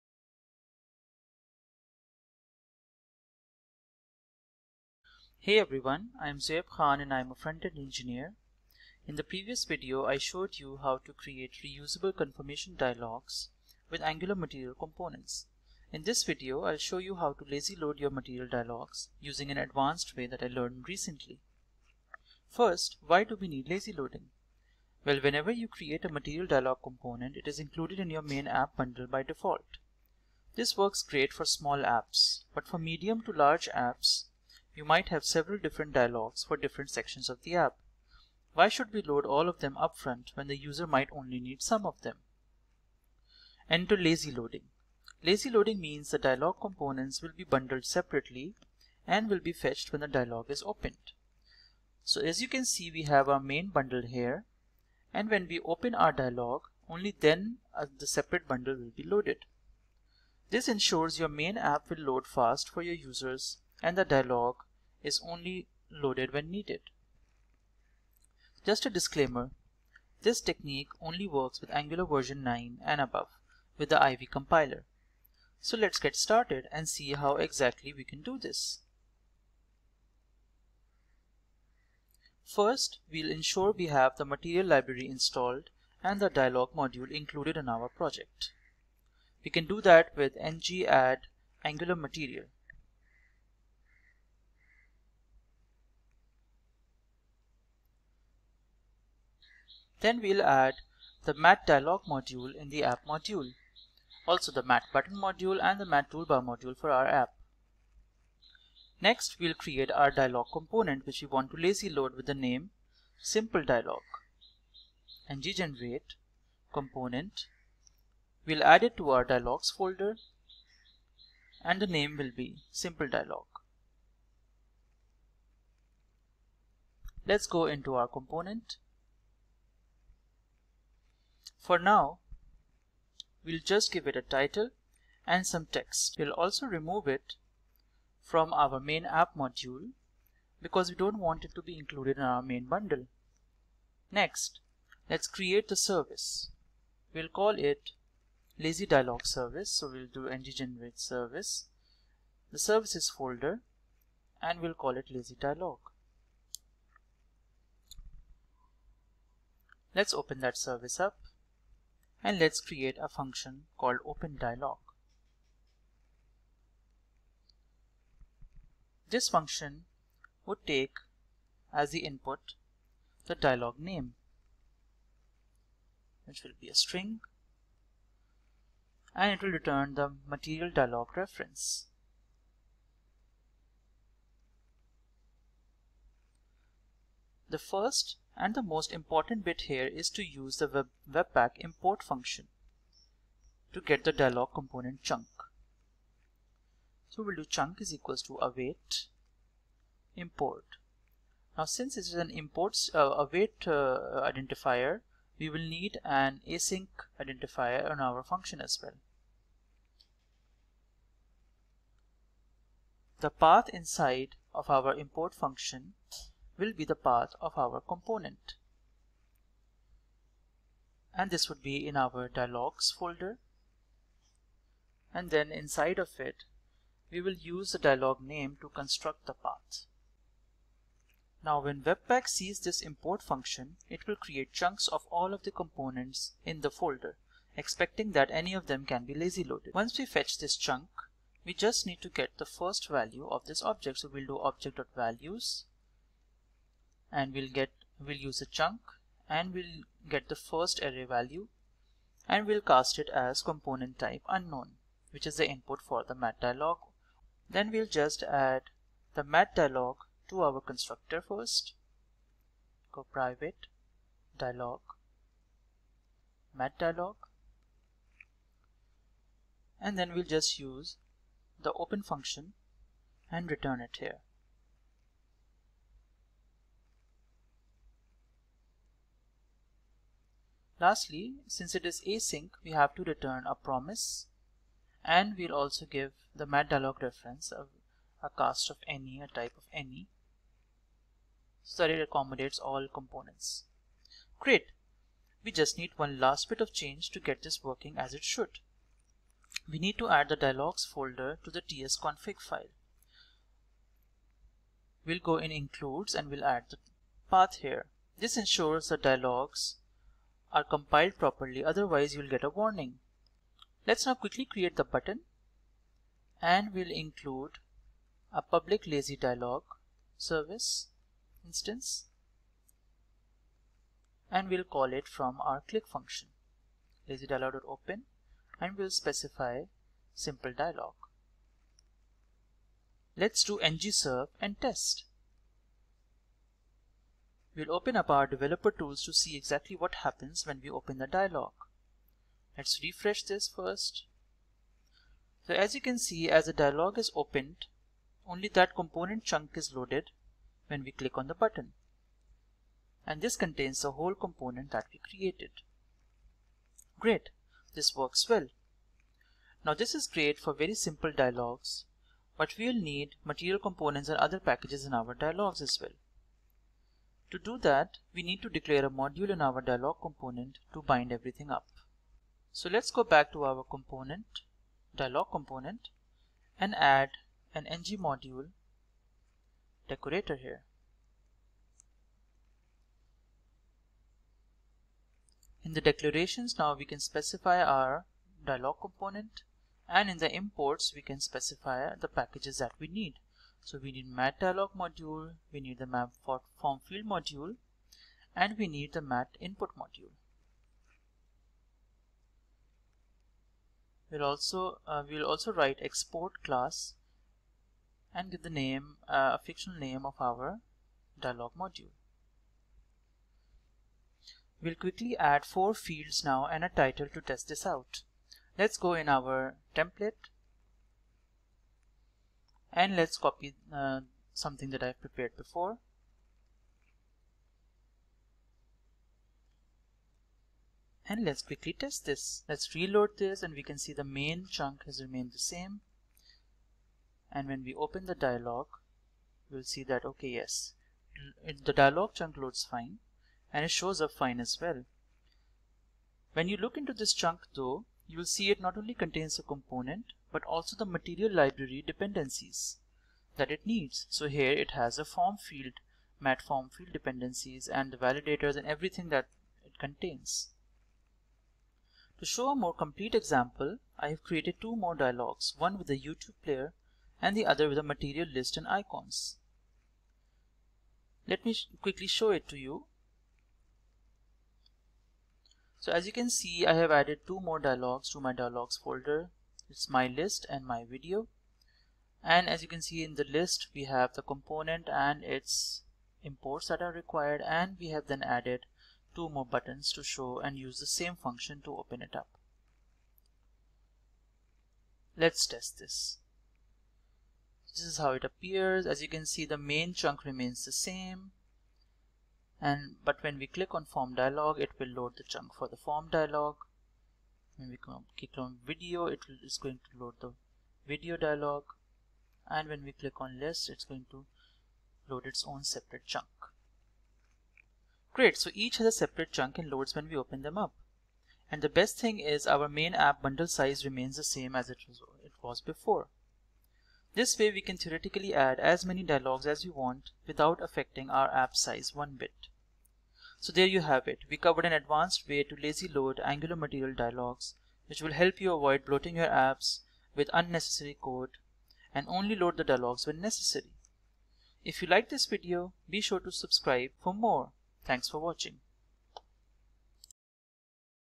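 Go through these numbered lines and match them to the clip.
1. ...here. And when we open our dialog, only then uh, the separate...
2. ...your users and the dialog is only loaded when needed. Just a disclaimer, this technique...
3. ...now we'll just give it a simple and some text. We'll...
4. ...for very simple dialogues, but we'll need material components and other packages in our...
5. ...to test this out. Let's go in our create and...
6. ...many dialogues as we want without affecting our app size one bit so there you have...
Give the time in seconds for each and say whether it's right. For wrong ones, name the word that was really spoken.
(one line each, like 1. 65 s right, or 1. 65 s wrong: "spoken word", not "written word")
1. 54 s right
2. 62 s right
3. 131 s wrong: "title", not "simple"
4. 360 s right
5. 417 s wrong: "template", not "create"
6. 528 s right.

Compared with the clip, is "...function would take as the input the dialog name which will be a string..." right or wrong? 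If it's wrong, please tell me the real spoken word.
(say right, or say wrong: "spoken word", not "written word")
right.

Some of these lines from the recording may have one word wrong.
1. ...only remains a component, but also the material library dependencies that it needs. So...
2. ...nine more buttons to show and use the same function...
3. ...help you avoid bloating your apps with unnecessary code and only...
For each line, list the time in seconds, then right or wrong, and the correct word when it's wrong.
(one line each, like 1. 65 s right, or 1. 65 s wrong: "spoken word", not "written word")
1. 448 s wrong: "contains", not "remains"
2. 489 s wrong: "two", not "nine"
3. 538 s right.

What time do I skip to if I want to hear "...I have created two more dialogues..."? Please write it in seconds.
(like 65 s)
463 s.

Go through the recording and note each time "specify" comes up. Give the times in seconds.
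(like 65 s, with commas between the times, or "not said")
328 s, 386 s, 391 s.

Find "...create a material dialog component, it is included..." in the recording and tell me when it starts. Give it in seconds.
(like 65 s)
25 s.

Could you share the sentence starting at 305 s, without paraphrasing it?
We'll go in includes and we'll add the path here.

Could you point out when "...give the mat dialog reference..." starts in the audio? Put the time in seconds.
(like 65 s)
285 s.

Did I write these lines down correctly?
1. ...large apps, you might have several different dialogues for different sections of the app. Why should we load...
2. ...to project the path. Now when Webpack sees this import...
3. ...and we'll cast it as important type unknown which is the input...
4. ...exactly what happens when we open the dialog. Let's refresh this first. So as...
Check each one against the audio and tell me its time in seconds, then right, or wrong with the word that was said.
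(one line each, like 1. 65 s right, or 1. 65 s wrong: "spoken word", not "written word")
1. 33 s right
2. 228 s wrong: "construct", not "project"
3. 252 s wrong: "component", not "important"
4. 339 s right.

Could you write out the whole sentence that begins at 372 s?
So let's go back to our component, dialog component, and add an ng module decorator here.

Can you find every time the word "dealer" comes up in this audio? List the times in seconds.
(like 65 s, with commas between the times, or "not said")
not said.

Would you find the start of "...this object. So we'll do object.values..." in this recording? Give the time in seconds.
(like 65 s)
243 s.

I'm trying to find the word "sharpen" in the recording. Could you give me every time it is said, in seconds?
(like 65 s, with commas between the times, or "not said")
not said.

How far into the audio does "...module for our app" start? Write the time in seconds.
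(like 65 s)
106 s.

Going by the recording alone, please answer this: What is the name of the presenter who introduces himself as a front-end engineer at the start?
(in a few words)
Zoaib Khan.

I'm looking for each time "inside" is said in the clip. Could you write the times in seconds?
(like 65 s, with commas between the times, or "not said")
213 s, 225 s.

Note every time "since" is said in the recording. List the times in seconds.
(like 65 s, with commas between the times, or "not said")
201 s, 281 s.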